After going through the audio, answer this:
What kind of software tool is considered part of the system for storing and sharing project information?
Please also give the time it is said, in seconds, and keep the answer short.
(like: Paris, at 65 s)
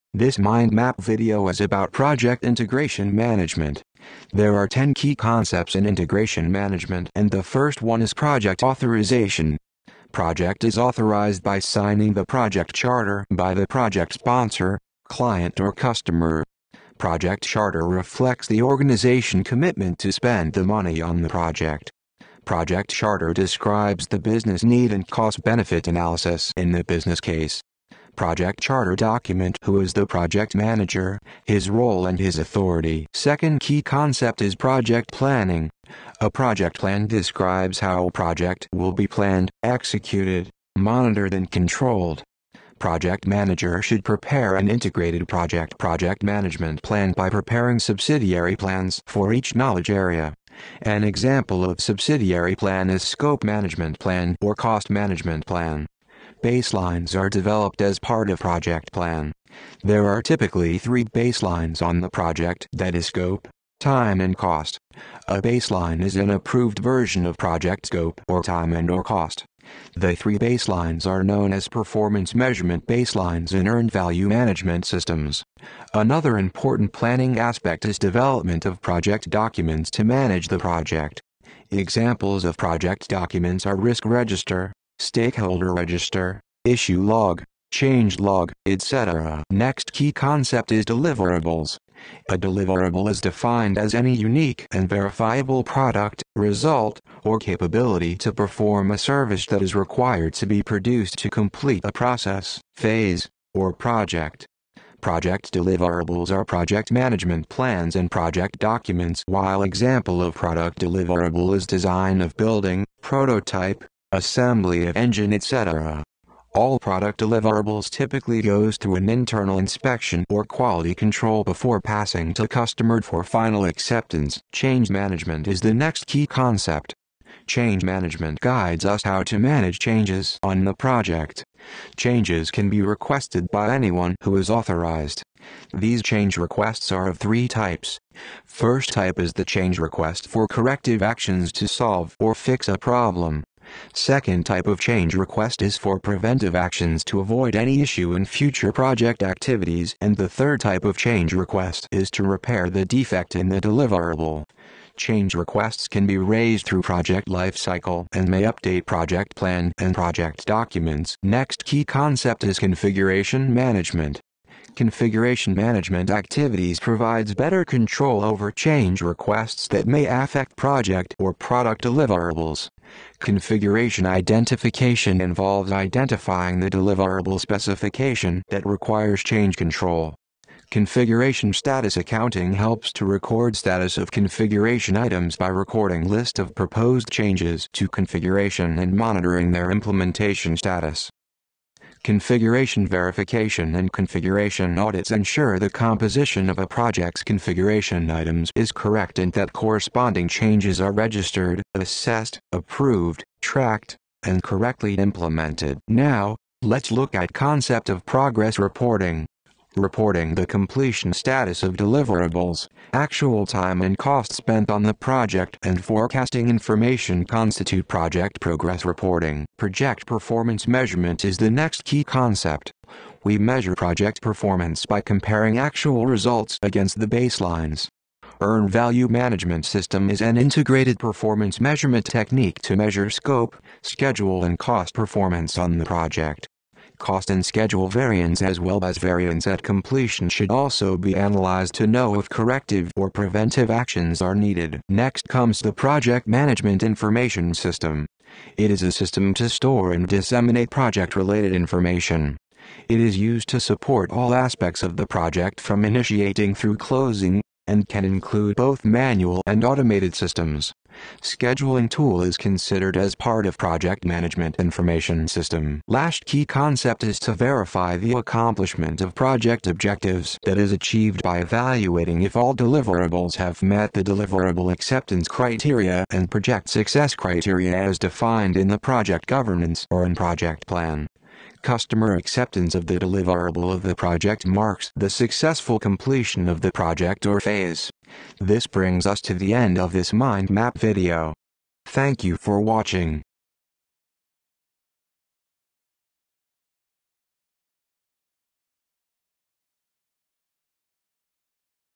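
scheduling tool, at 261 s.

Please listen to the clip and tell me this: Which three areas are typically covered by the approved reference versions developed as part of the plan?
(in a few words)
scope, time and cost.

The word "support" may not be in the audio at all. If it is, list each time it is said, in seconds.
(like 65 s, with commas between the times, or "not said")
253 s.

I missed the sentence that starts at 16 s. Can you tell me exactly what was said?
Project charter reflects the organization commitment to spend the money on the project.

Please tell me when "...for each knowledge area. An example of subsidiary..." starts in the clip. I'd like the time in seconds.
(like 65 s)
49 s.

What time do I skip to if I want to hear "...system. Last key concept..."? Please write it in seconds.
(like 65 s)
265 s.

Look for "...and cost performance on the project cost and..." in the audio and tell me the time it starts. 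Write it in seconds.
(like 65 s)
234 s.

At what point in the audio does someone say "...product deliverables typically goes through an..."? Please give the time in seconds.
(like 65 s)
116 s.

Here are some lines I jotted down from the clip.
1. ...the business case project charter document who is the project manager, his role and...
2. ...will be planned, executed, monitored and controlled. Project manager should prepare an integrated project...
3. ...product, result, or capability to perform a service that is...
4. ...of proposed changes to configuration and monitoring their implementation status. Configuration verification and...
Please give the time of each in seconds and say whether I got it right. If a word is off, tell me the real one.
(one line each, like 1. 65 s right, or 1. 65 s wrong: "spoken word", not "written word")
1. 26 s right
2. 38 s right
3. 95 s right
4. 186 s right.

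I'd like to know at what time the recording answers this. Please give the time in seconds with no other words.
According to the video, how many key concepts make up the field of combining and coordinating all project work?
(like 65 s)
4 s.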